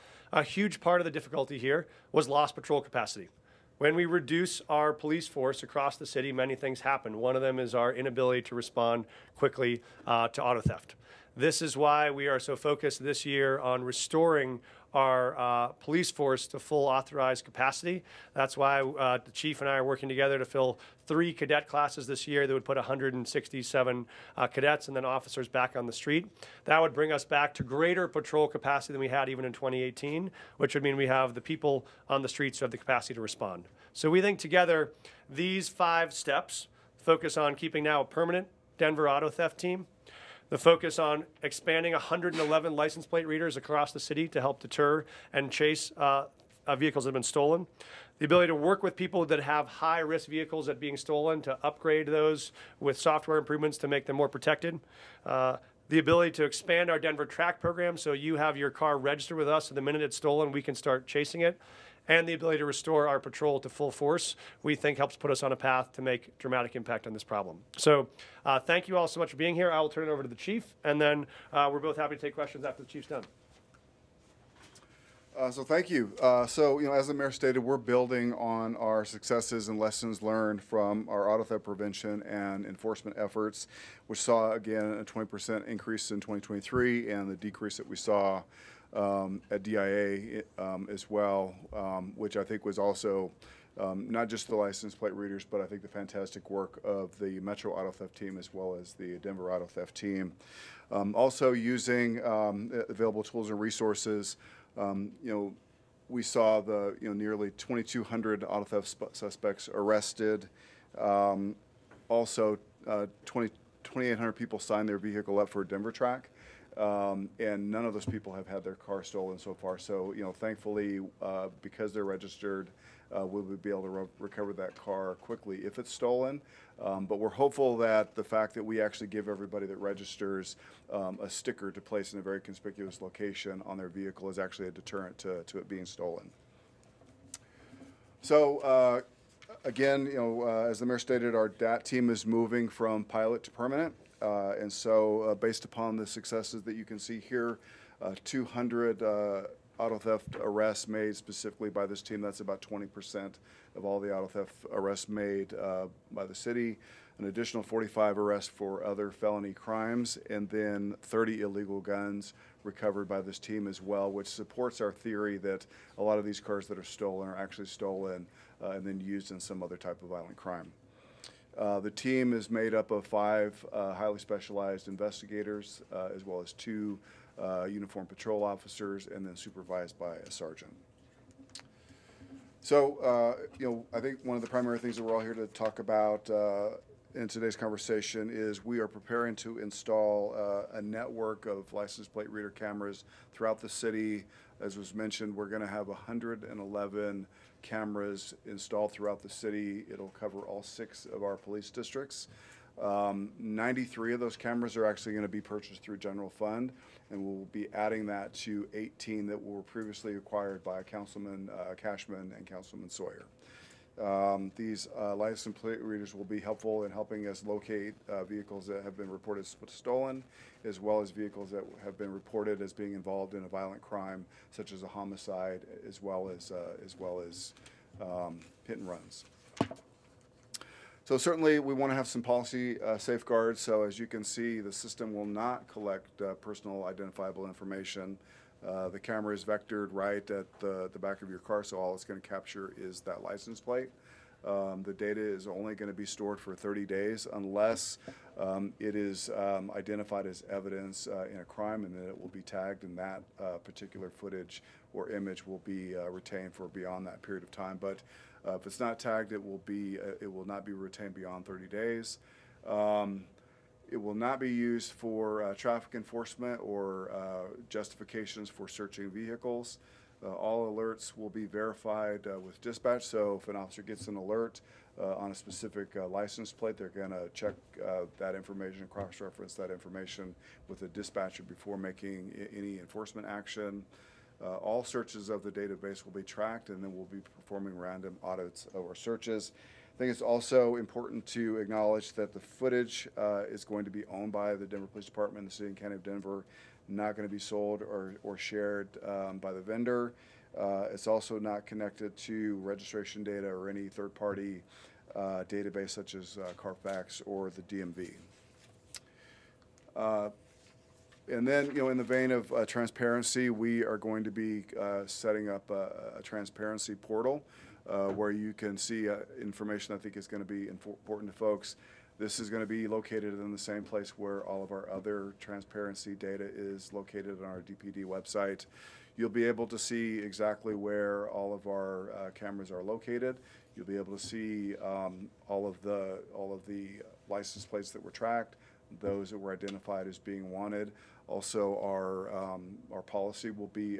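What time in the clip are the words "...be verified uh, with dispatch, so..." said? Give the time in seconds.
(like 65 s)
271 s.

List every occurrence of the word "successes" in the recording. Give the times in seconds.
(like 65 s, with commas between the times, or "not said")
79 s, 146 s.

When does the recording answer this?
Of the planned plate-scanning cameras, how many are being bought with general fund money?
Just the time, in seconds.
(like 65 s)
203 s.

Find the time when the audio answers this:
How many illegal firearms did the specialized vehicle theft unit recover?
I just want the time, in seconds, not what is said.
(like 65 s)
161 s.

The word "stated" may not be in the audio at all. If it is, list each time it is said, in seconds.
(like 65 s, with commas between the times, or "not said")
77 s, 140 s.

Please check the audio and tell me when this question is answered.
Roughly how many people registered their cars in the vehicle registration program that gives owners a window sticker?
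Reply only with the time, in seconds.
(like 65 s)
113 s.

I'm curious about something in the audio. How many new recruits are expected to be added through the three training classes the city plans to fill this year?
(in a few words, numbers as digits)
167.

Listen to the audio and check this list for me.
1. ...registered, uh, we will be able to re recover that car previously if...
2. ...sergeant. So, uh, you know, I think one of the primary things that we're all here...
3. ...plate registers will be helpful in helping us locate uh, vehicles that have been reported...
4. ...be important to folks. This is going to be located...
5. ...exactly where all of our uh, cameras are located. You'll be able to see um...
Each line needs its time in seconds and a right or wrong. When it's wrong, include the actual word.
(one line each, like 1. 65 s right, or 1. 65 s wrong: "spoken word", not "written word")
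1. 122 s wrong: "quickly", not "previously"
2. 180 s right
3. 215 s wrong: "readers", not "registers"
4. 320 s right
5. 330 s right.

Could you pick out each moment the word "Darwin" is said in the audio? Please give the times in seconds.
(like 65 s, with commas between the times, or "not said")
not said.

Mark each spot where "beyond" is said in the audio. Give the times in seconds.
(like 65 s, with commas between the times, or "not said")
256 s, 261 s.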